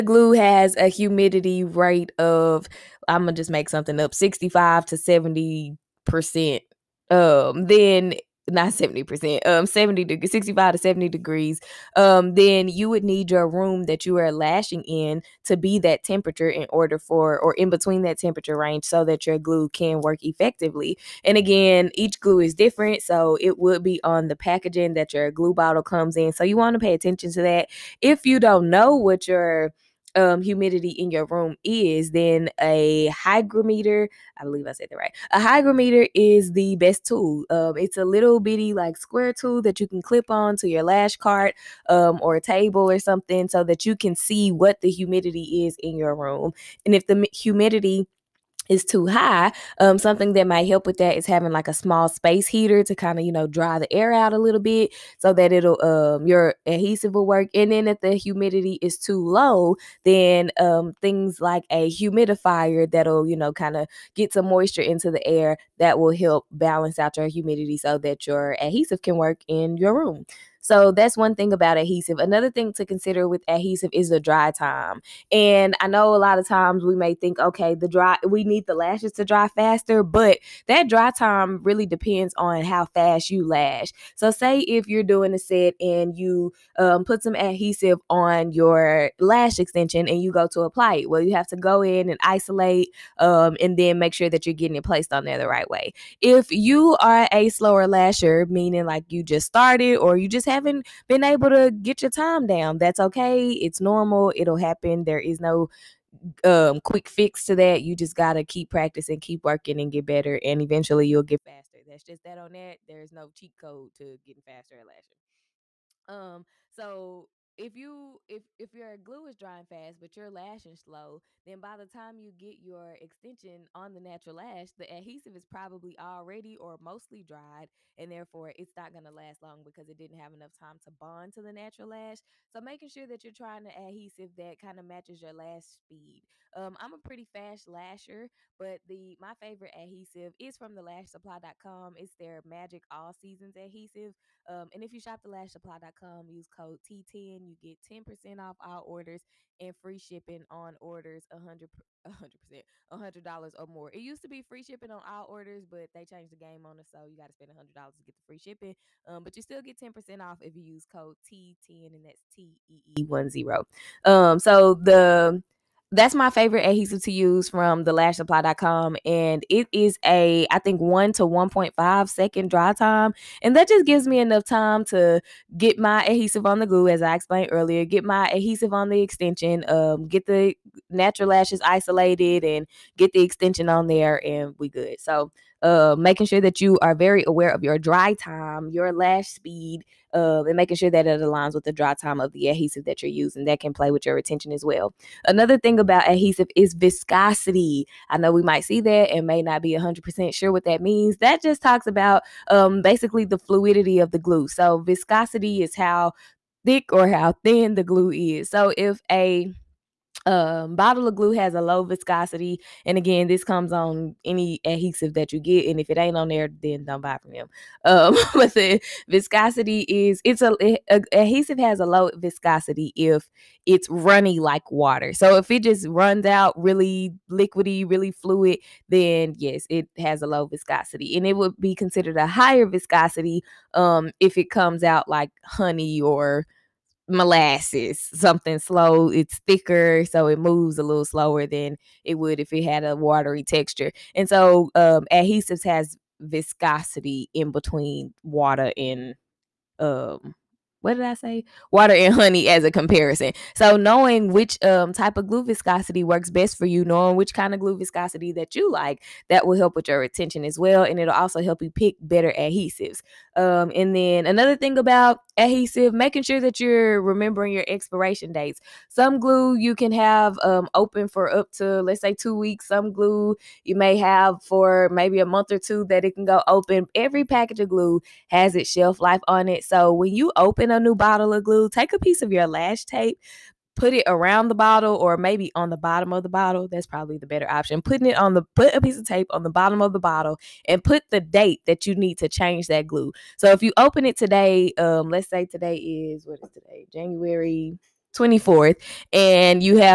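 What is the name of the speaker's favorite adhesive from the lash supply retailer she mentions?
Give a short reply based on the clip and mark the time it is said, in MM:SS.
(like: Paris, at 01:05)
Magic All Seasons, at 02:22.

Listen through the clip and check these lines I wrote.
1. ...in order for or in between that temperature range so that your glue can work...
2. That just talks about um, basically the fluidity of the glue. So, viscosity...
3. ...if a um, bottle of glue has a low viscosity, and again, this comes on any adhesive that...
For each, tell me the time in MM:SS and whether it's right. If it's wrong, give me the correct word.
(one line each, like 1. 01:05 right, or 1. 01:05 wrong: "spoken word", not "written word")
1. 00:16 right
2. 03:21 right
3. 03:28 right.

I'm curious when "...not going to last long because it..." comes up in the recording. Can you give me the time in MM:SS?
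02:08.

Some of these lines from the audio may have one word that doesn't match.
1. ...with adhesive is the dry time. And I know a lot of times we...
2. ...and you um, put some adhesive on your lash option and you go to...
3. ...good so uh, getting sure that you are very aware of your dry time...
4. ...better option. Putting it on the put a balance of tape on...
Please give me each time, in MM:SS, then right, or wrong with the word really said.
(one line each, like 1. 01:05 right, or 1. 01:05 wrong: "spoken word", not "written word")
1. 01:13 right
2. 01:25 wrong: "extension", not "option"
3. 03:04 wrong: "making", not "getting"
4. 04:47 wrong: "piece", not "balance".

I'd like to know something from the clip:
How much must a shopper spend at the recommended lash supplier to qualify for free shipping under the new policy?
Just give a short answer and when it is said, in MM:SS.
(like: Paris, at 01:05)
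$100, at 02:32.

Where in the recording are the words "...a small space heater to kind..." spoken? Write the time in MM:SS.
00:51.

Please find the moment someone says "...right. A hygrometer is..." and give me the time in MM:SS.
00:34.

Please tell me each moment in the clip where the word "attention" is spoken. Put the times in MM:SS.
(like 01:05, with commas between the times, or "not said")
00:26.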